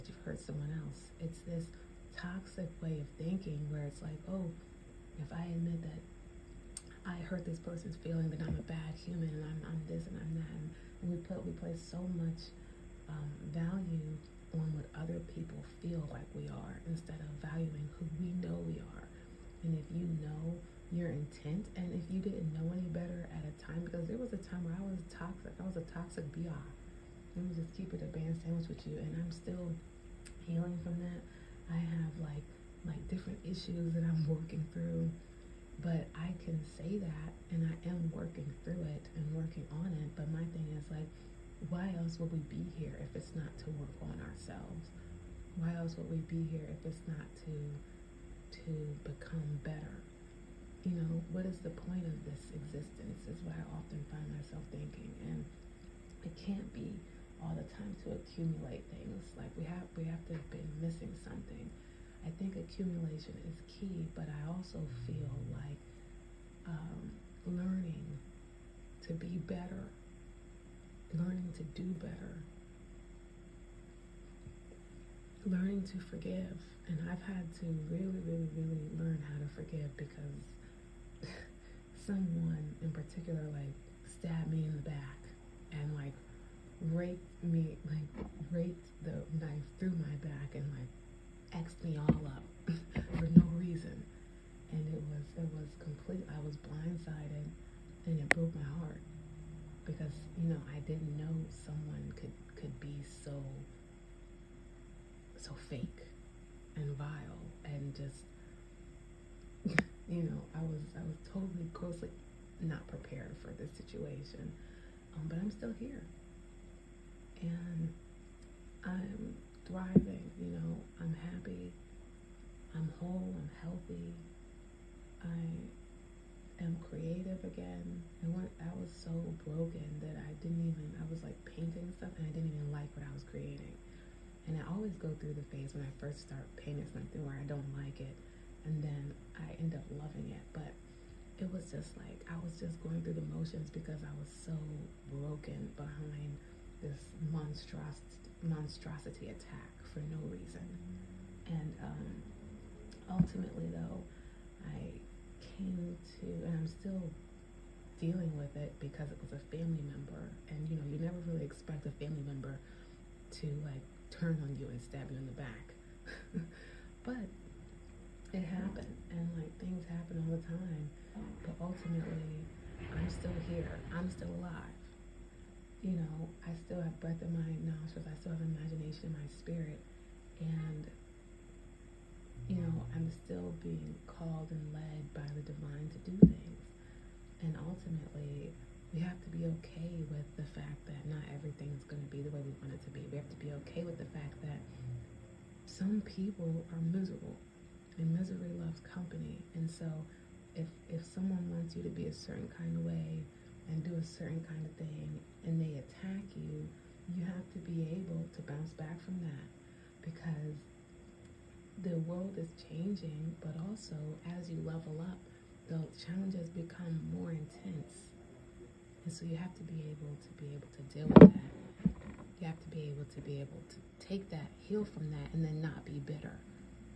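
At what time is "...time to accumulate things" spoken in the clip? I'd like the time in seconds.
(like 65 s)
57 s.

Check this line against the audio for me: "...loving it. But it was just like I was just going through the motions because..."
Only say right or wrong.
right.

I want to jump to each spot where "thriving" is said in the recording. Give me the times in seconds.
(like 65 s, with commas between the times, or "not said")
119 s.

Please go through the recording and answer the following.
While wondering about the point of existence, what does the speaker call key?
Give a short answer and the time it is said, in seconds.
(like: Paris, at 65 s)
accumulation, at 62 s.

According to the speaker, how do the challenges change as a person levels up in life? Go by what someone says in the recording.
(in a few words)
more intense.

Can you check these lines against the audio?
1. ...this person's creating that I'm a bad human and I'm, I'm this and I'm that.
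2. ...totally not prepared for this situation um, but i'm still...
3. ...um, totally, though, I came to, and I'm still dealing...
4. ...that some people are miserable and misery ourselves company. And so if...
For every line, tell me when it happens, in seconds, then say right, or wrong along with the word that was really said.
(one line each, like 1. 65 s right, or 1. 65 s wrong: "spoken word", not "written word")
1. 7 s wrong: "feeling", not "creating"
2. 111 s wrong: "grossly", not "totally"
3. 151 s wrong: "ultimately", not "totally"
4. 194 s wrong: "loves", not "ourselves".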